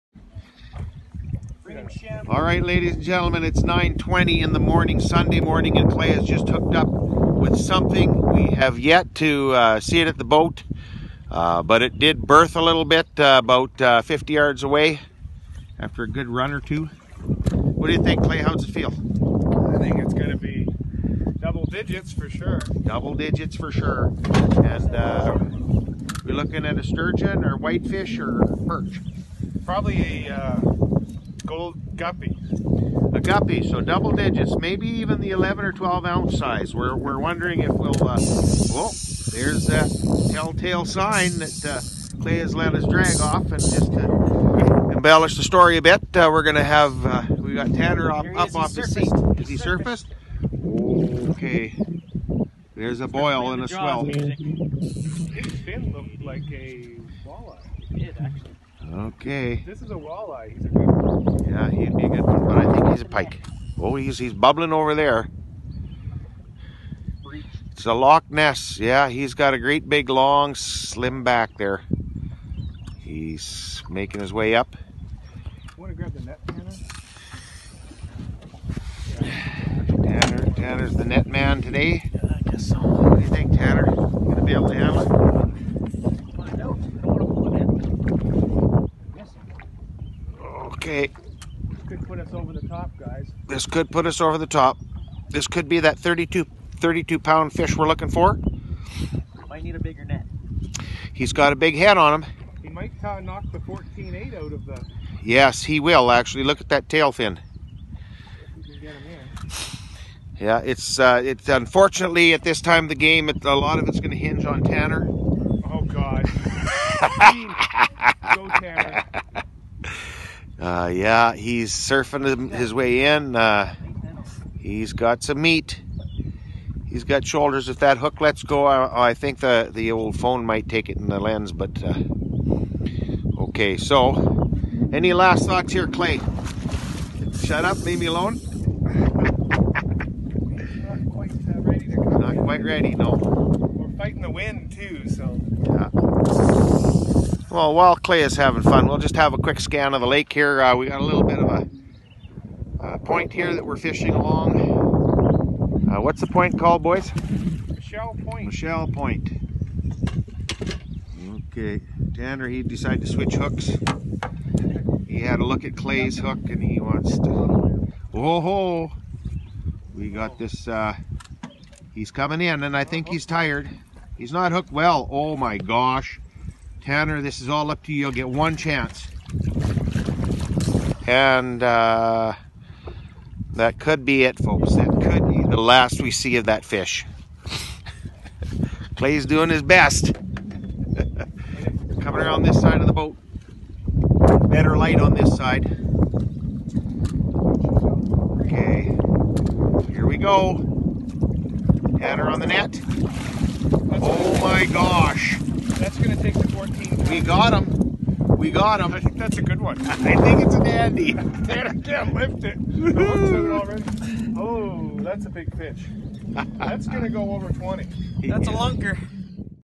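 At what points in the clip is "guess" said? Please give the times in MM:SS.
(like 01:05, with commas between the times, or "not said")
01:22.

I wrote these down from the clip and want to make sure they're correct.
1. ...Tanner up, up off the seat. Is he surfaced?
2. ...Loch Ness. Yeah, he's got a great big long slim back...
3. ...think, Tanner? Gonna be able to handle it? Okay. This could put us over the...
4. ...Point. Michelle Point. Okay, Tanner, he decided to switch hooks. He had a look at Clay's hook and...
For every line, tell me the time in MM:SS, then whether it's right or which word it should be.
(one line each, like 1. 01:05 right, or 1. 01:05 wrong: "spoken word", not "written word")
1. 00:47 right
2. 01:07 right
3. 01:23 right
4. 02:38 right.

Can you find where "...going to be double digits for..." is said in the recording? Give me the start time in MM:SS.
00:20.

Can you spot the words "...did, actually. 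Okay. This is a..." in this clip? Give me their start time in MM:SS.
00:57.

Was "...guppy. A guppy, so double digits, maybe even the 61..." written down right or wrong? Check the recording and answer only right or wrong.
wrong.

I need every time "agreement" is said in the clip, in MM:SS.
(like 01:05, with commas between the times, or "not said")
not said.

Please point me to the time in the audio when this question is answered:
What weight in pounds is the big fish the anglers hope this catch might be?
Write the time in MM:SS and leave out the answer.
01:36.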